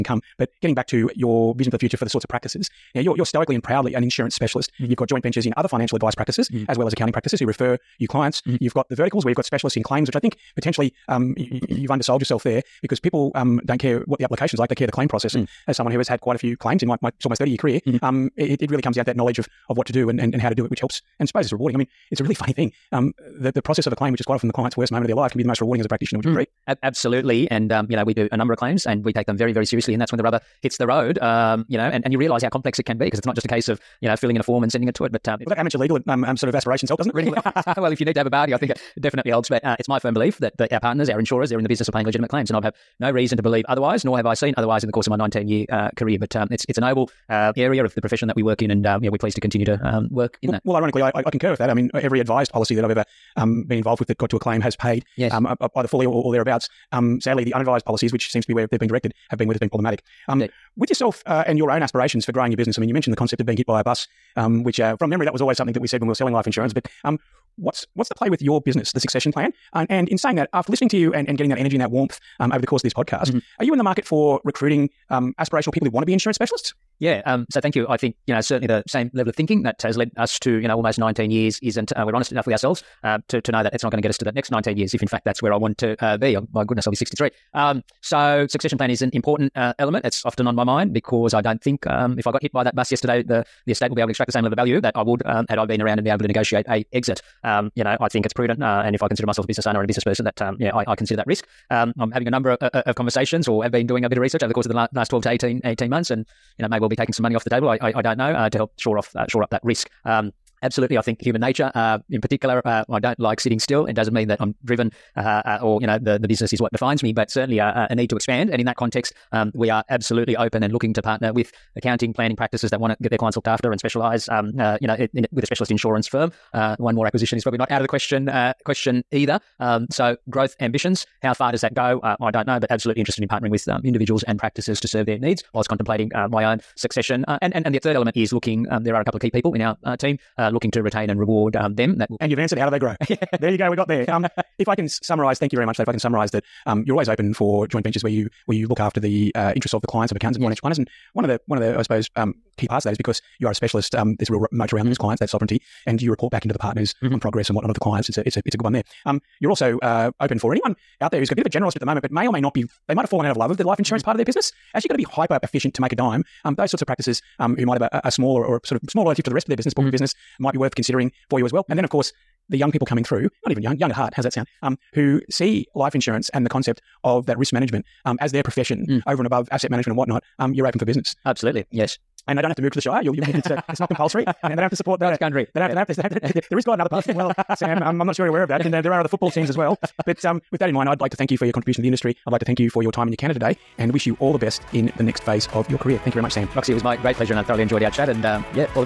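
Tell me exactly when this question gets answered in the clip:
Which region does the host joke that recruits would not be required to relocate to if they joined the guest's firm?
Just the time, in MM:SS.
03:02.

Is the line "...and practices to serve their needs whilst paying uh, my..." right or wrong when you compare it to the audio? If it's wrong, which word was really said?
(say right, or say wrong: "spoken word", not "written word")
wrong: "contemplating", not "paying".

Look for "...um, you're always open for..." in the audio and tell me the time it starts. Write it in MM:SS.
02:26.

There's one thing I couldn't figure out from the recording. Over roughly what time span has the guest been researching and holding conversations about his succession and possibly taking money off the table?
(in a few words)
12 to 18 months.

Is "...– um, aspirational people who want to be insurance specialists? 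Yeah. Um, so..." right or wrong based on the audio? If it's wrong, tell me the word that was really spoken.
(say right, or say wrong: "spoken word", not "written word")
right.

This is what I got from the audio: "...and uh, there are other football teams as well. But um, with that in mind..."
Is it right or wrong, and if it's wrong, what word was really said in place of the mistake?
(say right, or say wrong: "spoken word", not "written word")
right.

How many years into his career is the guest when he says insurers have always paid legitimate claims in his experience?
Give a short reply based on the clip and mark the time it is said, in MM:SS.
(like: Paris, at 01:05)
19, at 00:45.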